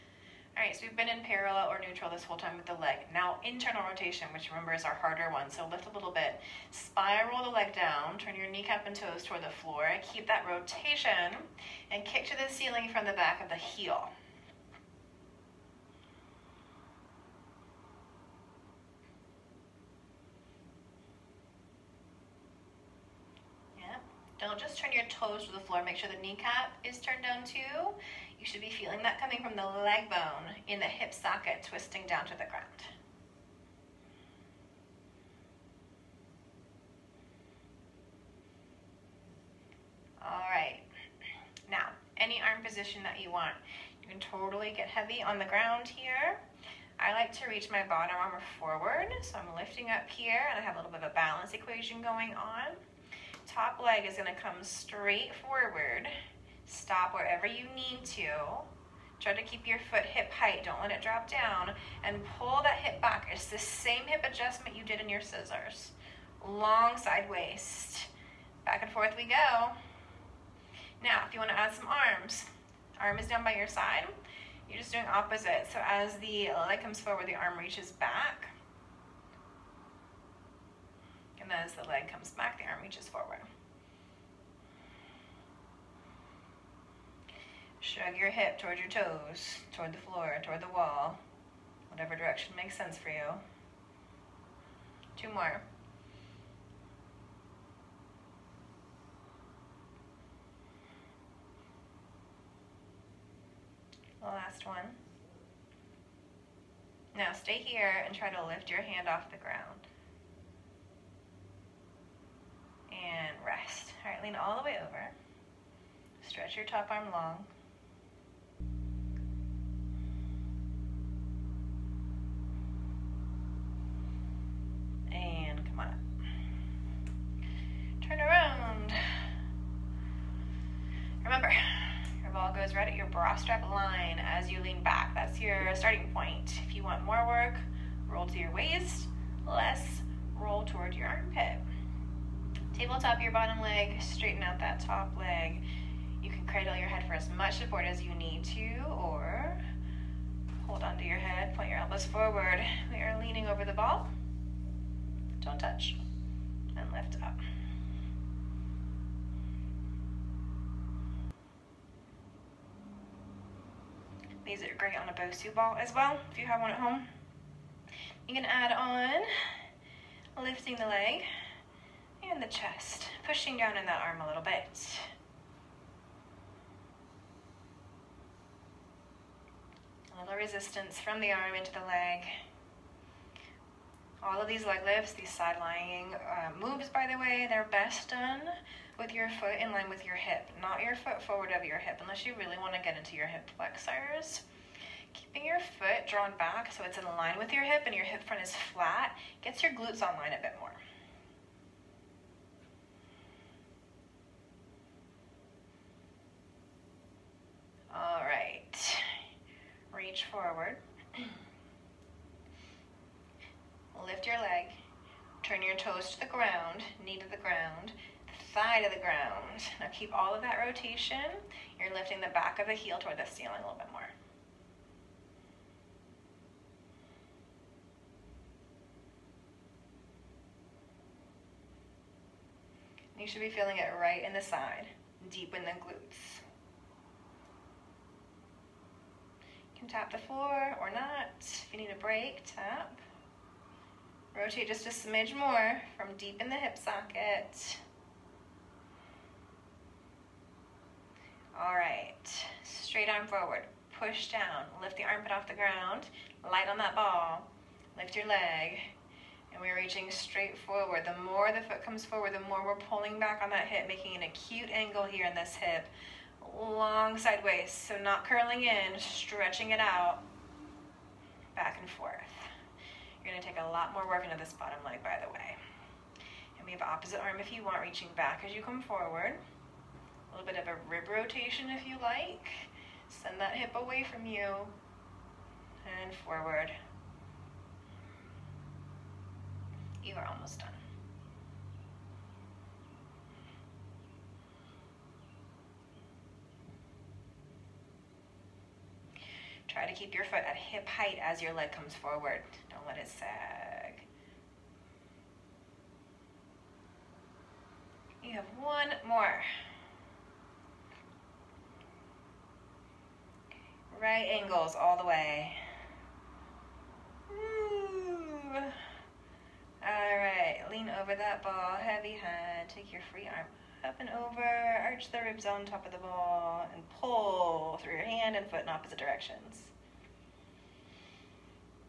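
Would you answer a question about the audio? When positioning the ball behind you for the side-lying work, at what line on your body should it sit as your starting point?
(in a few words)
Bra strap line.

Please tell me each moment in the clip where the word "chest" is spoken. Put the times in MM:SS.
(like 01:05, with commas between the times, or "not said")
02:52.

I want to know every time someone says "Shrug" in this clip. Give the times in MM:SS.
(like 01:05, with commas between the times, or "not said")
01:27.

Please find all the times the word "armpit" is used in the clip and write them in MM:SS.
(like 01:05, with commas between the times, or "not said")
02:21, 04:15.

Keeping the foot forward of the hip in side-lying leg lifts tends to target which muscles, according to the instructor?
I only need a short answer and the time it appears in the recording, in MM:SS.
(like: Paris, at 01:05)
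Hip flexors, at 03:13.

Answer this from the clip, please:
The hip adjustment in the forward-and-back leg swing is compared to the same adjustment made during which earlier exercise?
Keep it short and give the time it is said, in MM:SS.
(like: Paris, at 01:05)
Scissors, at 01:05.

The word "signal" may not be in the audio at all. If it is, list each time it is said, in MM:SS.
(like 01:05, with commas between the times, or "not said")
not said.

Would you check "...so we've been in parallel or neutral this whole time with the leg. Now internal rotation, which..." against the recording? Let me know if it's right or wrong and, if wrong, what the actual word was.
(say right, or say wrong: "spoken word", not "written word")
right.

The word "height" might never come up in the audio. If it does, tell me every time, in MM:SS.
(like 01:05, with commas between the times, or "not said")
01:00, 05:00.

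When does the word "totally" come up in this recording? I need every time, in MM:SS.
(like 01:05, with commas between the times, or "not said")
00:44.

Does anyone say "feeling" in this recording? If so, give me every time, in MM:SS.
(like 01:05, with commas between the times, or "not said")
00:28, 03:53.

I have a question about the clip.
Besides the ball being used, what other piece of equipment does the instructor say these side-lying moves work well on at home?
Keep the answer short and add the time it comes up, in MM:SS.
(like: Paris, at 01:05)
Bosu ball, at 02:45.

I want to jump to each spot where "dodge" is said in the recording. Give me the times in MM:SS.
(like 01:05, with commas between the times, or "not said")
not said.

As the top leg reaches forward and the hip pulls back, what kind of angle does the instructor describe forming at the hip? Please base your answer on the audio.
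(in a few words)
Acute angle.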